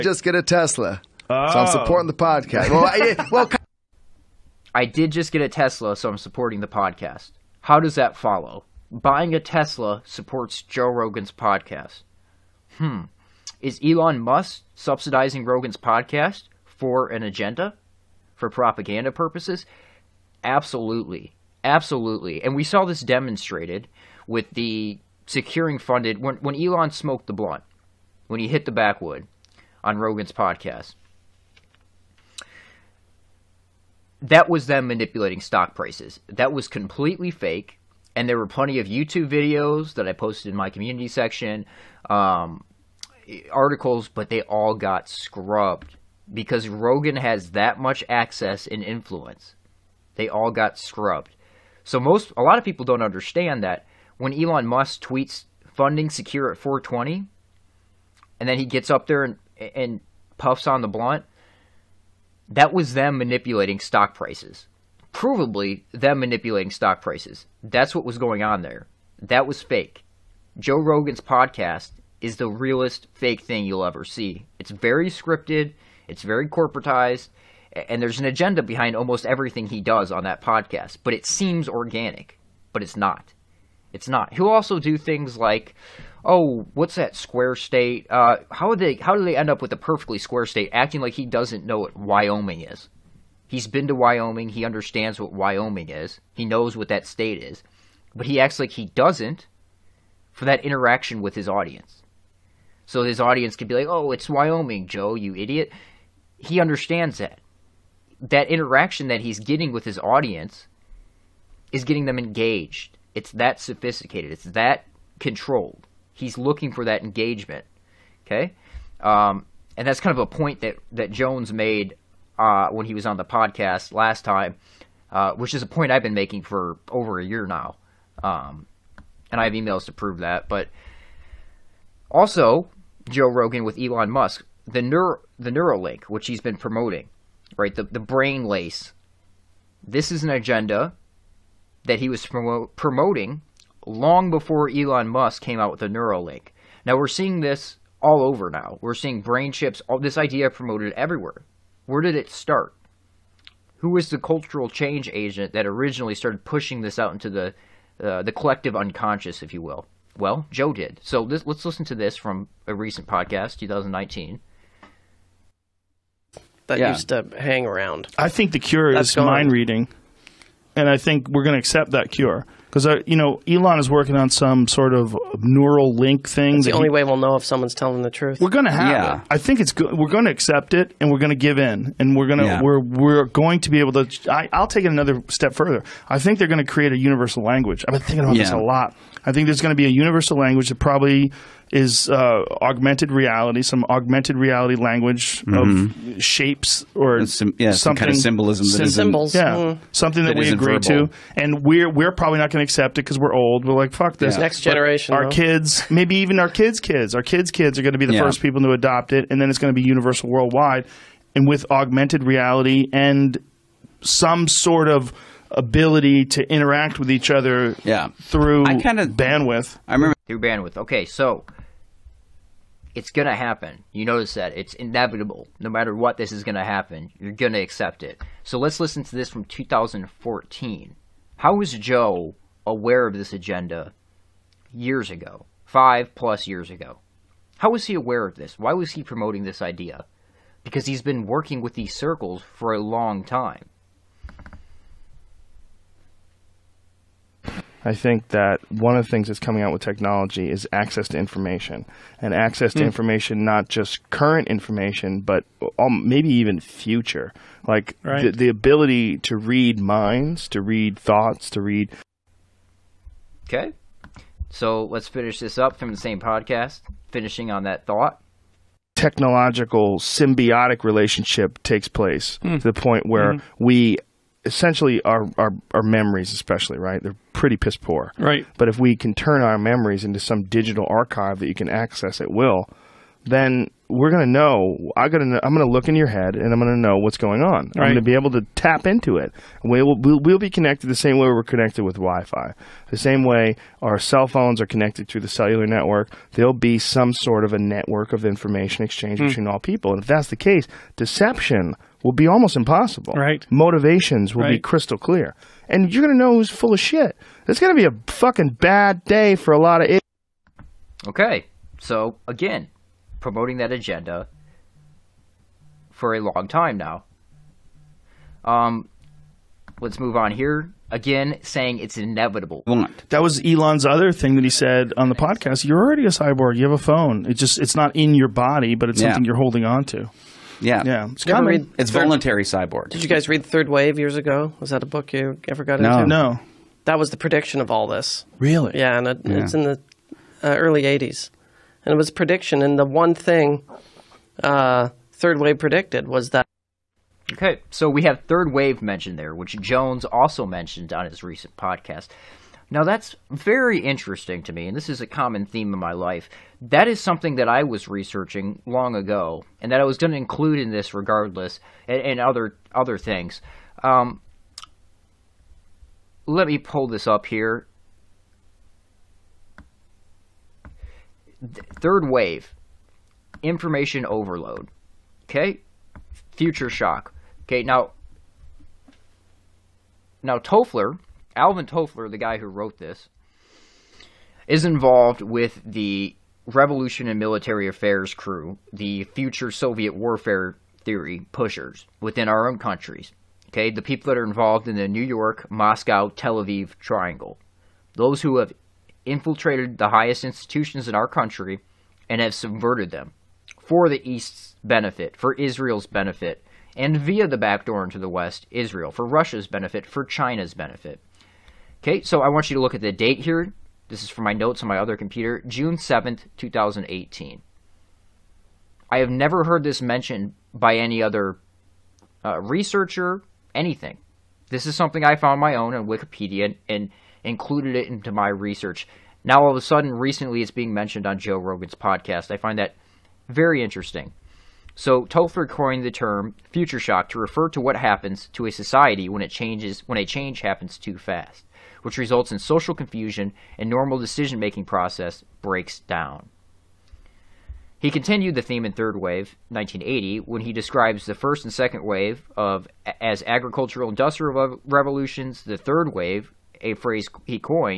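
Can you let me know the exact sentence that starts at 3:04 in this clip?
I, will take it another step further.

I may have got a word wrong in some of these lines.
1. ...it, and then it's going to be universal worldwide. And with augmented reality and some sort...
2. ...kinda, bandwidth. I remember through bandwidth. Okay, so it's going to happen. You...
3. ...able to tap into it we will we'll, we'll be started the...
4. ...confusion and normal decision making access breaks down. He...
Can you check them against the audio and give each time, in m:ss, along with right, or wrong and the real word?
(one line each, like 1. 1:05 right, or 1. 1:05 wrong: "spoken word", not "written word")
1. 3:29 right
2. 3:38 right
3. 4:48 wrong: "connected", not "started"
4. 7:22 wrong: "process", not "access".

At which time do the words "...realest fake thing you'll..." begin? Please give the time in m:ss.
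1:12.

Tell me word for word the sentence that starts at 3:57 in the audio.
How was he aware of this?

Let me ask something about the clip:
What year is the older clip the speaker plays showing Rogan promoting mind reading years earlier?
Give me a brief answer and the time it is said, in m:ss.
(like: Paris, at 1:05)
2014, at 3:49.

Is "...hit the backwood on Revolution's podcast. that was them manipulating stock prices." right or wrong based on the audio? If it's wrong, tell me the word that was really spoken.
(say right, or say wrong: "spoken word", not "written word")
wrong: "Rogan", not "Revolution".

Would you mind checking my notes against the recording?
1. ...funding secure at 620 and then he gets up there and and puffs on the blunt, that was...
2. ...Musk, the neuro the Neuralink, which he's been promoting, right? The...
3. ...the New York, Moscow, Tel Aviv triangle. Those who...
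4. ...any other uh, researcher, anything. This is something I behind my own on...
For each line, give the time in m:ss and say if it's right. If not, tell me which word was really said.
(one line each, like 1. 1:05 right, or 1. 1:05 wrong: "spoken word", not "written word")
1. 0:55 wrong: "420", not "620"
2. 2:14 right
3. 6:34 right
4. 7:00 wrong: "found", not "behind".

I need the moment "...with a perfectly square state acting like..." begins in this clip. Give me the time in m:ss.
1:29.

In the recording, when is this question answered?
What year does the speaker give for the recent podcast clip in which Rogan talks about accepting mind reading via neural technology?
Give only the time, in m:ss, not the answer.
2:43.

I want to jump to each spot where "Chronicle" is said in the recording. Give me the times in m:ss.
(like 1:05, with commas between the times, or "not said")
not said.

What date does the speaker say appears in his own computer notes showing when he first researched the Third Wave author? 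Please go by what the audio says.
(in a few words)
June 7, 2018.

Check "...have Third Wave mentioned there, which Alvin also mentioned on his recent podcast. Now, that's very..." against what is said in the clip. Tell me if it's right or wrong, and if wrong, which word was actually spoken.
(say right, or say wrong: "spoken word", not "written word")
wrong: "Jones", not "Alvin".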